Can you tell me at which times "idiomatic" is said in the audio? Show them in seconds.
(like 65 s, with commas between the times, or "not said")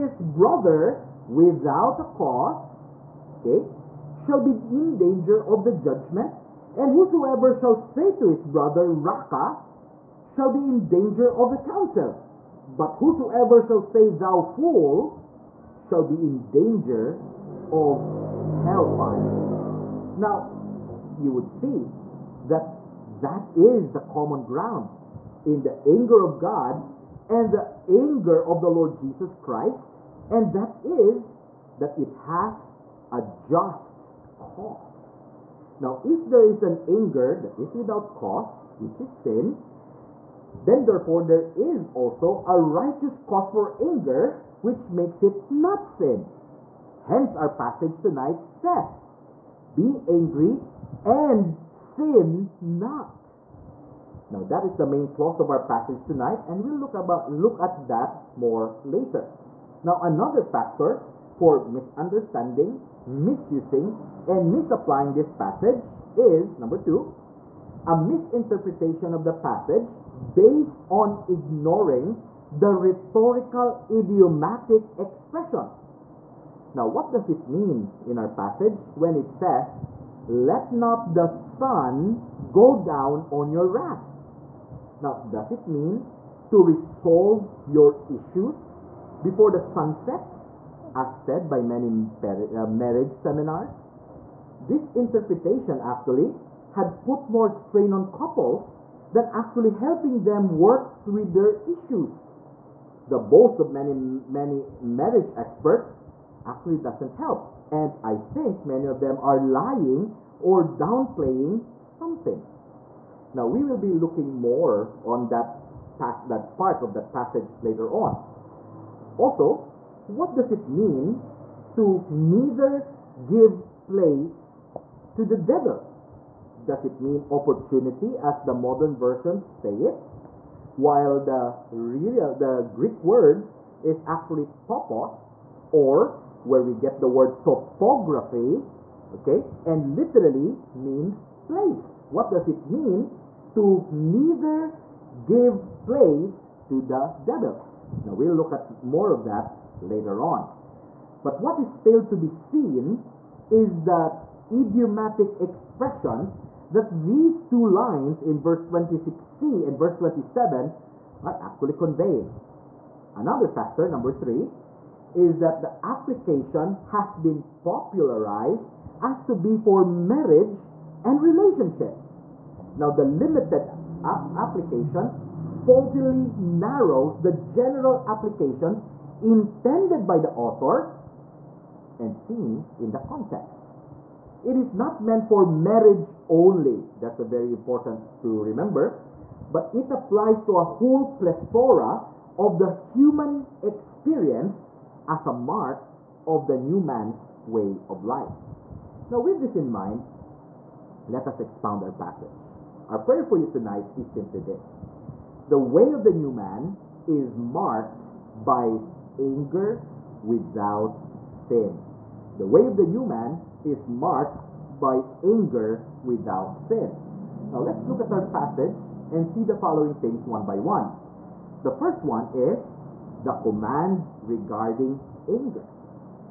73 s, 154 s.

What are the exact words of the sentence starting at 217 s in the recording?
Now let's look at our passage and see the following things one by one.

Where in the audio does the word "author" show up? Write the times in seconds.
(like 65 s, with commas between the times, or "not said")
180 s.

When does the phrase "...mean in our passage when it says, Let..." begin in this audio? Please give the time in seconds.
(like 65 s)
77 s.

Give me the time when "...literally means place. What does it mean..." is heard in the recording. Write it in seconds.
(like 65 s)
139 s.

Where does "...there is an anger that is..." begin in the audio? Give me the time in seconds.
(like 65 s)
36 s.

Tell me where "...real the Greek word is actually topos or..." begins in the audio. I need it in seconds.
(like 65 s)
131 s.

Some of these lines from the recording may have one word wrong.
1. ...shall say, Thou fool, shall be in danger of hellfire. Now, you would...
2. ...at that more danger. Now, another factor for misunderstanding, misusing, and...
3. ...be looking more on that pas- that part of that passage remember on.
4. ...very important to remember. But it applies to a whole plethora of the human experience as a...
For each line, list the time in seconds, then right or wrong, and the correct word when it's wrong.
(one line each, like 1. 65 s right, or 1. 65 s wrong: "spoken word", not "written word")
1. 13 s right
2. 57 s wrong: "later", not "danger"
3. 113 s wrong: "later", not "remember"
4. 187 s right.